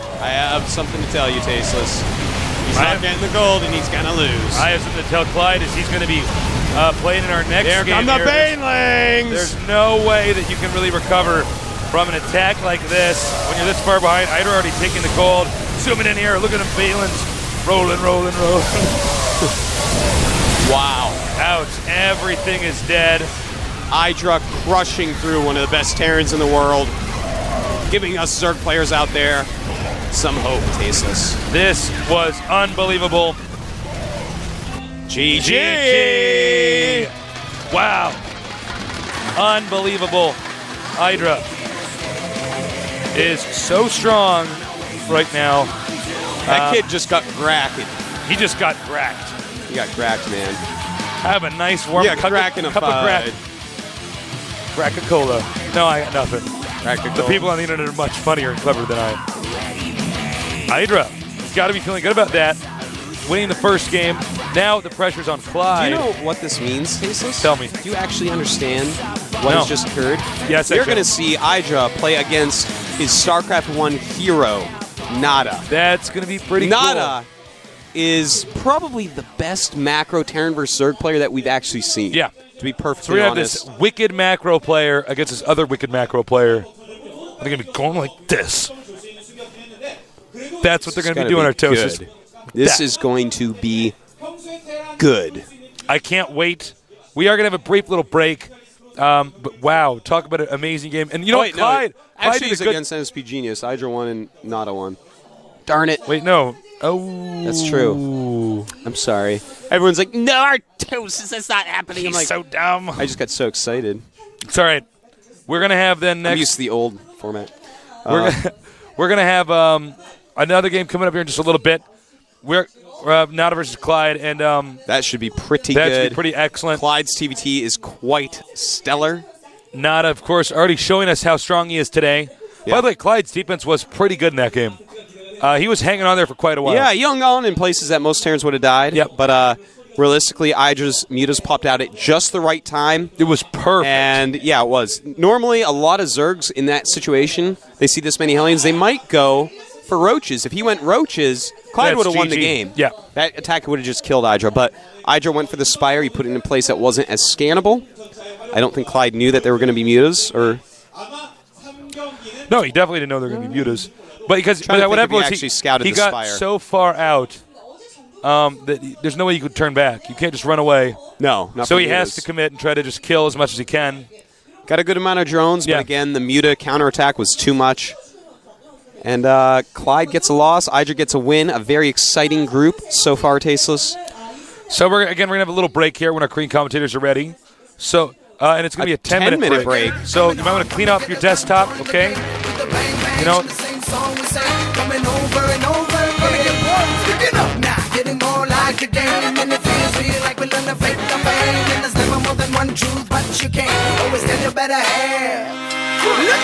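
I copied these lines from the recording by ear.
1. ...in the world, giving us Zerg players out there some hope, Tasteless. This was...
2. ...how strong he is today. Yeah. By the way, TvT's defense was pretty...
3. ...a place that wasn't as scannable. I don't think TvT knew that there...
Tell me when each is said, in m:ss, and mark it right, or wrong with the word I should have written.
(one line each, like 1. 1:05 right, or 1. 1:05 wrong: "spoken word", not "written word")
1. 0:26 right
2. 2:11 wrong: "Clide", not "TvT"
3. 2:36 wrong: "Clide", not "TvT".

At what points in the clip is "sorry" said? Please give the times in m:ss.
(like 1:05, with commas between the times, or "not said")
1:48.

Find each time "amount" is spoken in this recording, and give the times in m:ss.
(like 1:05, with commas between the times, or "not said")
2:54.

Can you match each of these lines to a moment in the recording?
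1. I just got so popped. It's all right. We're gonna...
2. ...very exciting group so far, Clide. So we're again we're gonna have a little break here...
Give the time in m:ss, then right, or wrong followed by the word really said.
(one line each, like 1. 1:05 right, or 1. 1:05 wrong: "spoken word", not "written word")
1. 1:52 wrong: "excited", not "popped"
2. 3:01 wrong: "Tasteless", not "Clide".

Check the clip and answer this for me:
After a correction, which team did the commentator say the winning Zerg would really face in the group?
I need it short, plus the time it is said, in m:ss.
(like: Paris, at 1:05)
NSP Genius, at 1:42.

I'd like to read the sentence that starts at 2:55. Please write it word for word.
but again, the Muta counterattack was too much.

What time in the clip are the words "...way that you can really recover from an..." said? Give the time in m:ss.
0:10.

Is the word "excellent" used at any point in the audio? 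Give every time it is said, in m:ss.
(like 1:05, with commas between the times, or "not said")
2:06.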